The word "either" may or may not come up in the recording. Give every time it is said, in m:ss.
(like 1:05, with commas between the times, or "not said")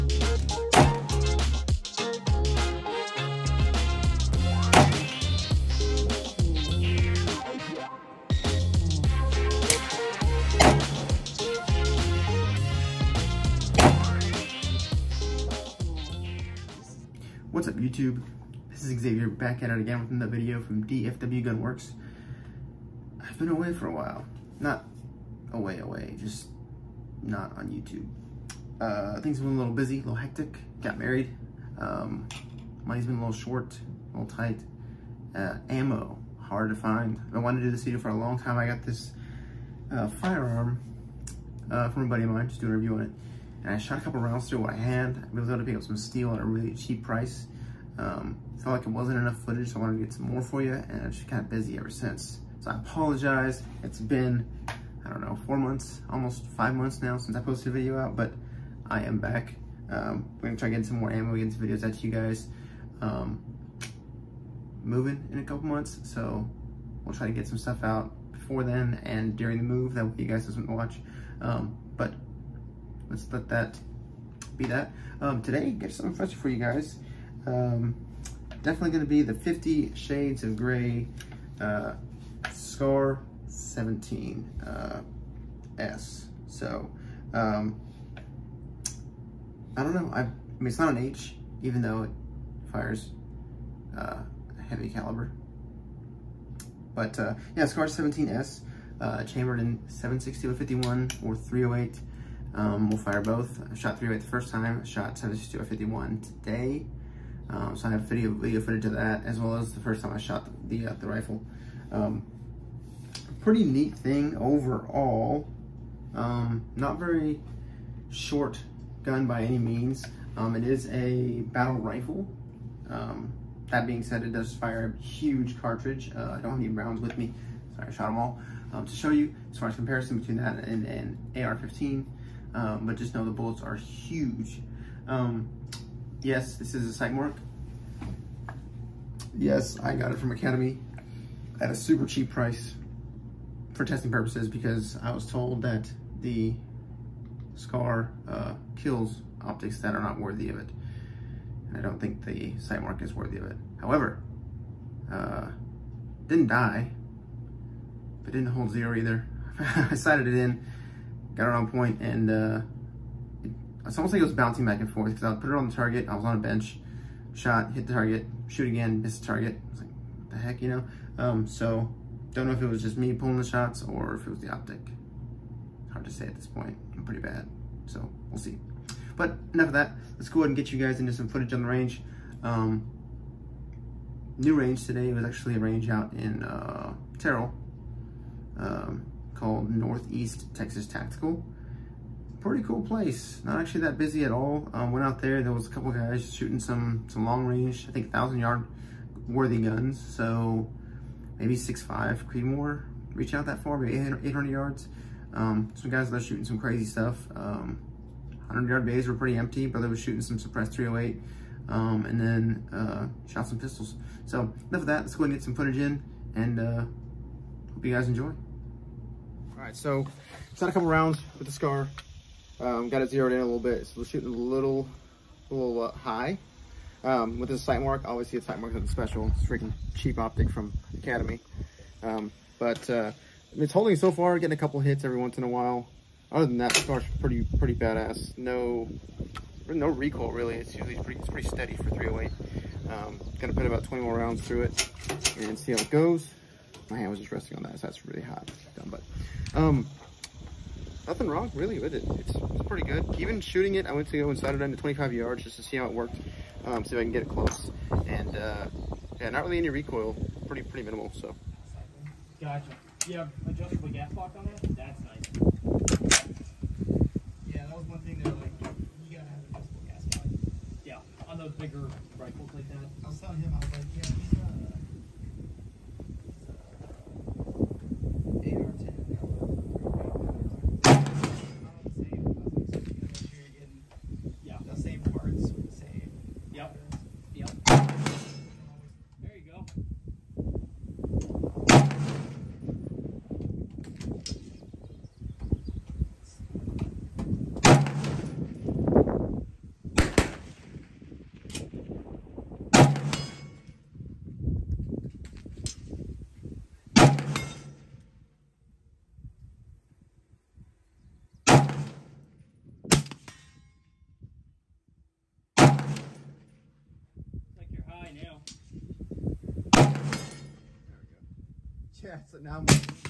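2:38.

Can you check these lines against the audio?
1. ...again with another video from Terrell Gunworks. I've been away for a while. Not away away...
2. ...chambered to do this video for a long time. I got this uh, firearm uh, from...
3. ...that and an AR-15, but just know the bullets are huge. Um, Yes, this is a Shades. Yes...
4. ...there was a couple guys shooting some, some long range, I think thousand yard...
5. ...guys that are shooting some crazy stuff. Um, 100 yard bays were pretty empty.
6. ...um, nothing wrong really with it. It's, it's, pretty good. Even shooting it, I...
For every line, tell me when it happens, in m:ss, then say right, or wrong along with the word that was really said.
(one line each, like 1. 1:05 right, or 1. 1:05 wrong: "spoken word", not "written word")
1. 0:19 wrong: "DFW", not "Terrell"
2. 0:37 wrong: "wanted", not "chambered"
3. 2:10 wrong: "Sightmark", not "Shades"
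4. 3:15 right
5. 3:25 right
6. 4:09 right.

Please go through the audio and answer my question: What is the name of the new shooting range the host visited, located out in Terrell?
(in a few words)
Northeast Texas Tactical.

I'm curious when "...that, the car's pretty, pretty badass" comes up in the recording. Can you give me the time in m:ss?
3:56.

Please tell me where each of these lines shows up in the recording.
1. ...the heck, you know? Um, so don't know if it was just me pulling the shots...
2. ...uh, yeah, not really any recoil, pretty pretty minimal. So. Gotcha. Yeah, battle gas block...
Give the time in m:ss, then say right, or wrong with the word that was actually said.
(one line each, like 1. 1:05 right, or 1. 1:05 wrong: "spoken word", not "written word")
1. 2:50 right
2. 4:18 wrong: "adjustable", not "battle".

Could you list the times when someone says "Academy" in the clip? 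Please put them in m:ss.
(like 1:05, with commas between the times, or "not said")
2:20, 3:51.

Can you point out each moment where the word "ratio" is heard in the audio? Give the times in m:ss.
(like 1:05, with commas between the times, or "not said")
not said.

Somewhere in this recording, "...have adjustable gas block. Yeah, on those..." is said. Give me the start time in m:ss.
4:29.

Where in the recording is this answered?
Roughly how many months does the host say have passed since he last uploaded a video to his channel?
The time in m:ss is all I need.
0:56.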